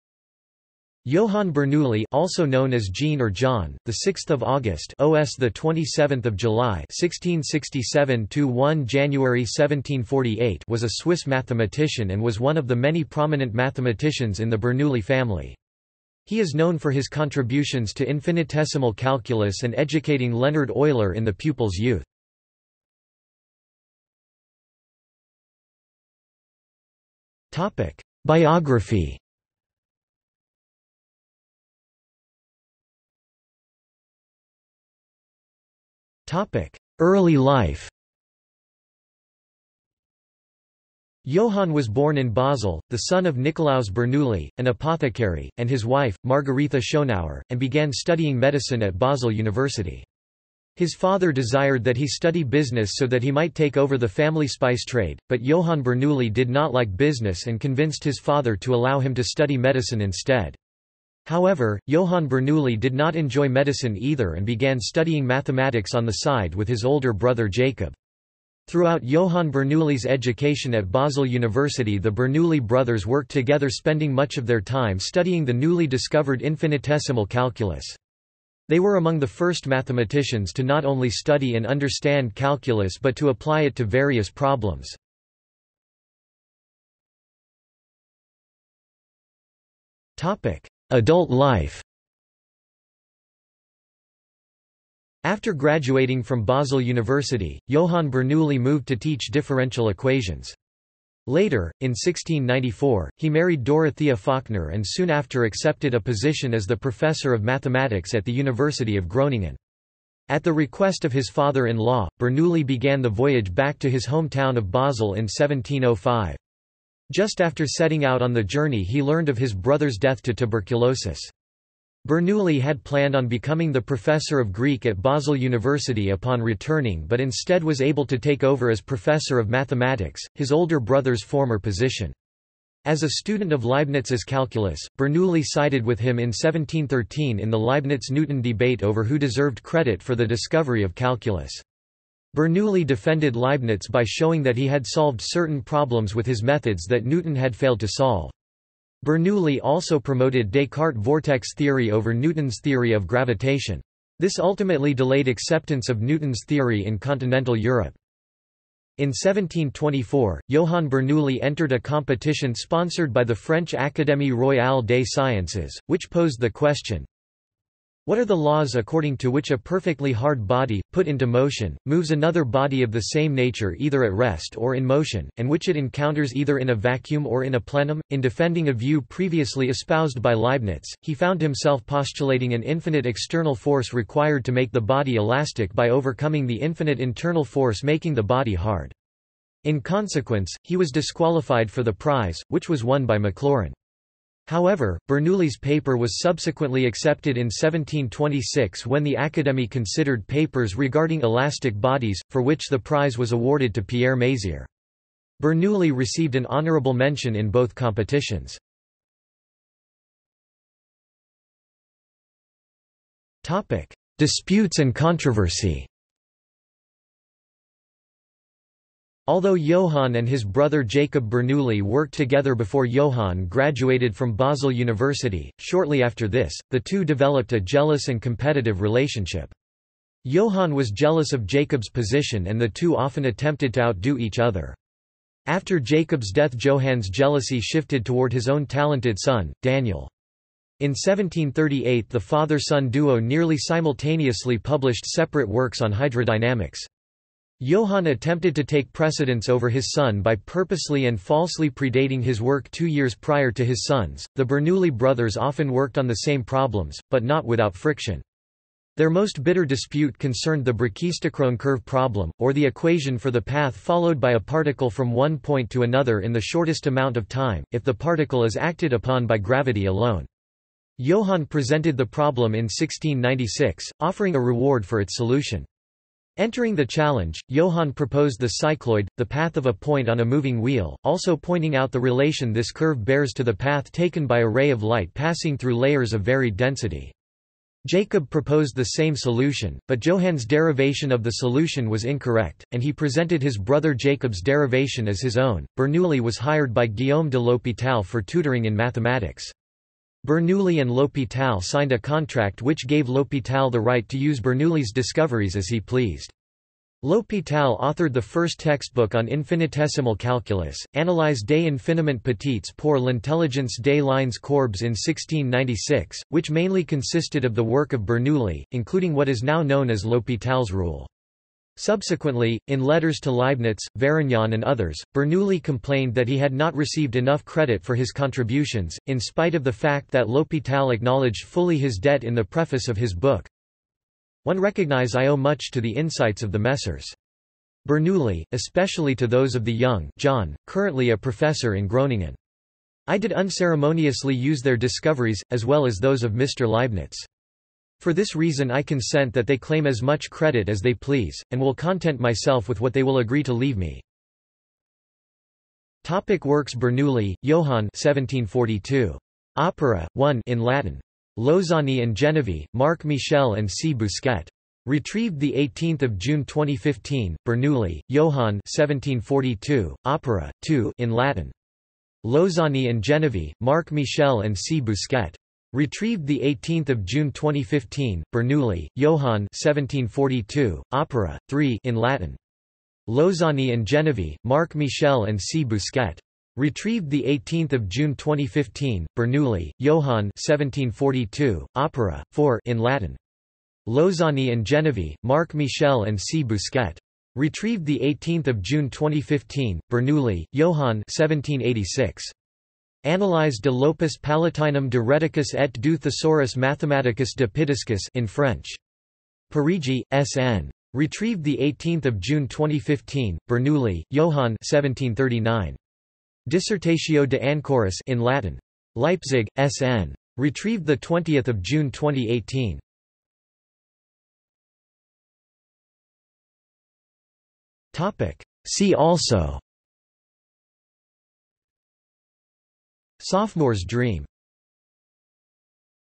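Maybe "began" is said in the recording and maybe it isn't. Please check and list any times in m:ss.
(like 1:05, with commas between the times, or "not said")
0:47, 1:04, 1:52.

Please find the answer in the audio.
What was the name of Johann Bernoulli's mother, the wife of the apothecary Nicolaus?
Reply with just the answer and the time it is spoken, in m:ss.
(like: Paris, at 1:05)
Margaretha Schongauer, at 0:46.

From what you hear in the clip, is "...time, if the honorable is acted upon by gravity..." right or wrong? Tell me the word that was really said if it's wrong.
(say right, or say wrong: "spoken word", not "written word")
wrong: "particle", not "honorable".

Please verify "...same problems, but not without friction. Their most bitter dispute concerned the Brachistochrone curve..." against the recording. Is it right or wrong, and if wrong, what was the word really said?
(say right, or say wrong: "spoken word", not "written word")
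right.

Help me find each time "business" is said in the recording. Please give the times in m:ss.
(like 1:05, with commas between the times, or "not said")
0:52, 0:56.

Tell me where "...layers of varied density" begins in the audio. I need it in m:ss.
4:45.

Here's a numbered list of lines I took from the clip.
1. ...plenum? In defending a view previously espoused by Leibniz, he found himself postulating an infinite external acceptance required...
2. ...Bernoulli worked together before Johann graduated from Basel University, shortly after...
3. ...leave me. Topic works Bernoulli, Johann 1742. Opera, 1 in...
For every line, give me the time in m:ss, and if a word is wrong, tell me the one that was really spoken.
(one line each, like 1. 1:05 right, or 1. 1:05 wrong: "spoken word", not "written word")
1. 2:57 wrong: "force", not "acceptance"
2. 3:41 right
3. 5:53 right.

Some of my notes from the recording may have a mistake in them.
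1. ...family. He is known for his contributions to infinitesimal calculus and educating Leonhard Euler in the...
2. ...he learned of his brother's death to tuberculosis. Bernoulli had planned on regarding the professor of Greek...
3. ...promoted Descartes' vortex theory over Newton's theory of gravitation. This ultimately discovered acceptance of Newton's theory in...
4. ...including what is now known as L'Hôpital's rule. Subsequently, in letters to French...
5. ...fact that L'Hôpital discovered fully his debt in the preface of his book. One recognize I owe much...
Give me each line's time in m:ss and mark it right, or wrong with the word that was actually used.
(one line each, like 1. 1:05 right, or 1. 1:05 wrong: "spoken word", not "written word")
1. 0:15 right
2. 1:58 wrong: "becoming", not "regarding"
3. 2:29 wrong: "delayed", not "discovered"
4. 5:18 wrong: "Leibniz", not "French"
5. 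5:29 wrong: "acknowledged", not "discovered".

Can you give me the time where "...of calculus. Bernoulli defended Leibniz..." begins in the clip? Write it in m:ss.
2:20.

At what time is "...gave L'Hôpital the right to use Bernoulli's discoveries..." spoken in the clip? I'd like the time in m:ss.
5:02.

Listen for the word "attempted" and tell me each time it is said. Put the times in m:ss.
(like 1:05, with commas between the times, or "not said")
3:53, 4:08.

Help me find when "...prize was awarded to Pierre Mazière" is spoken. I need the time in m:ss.
3:22.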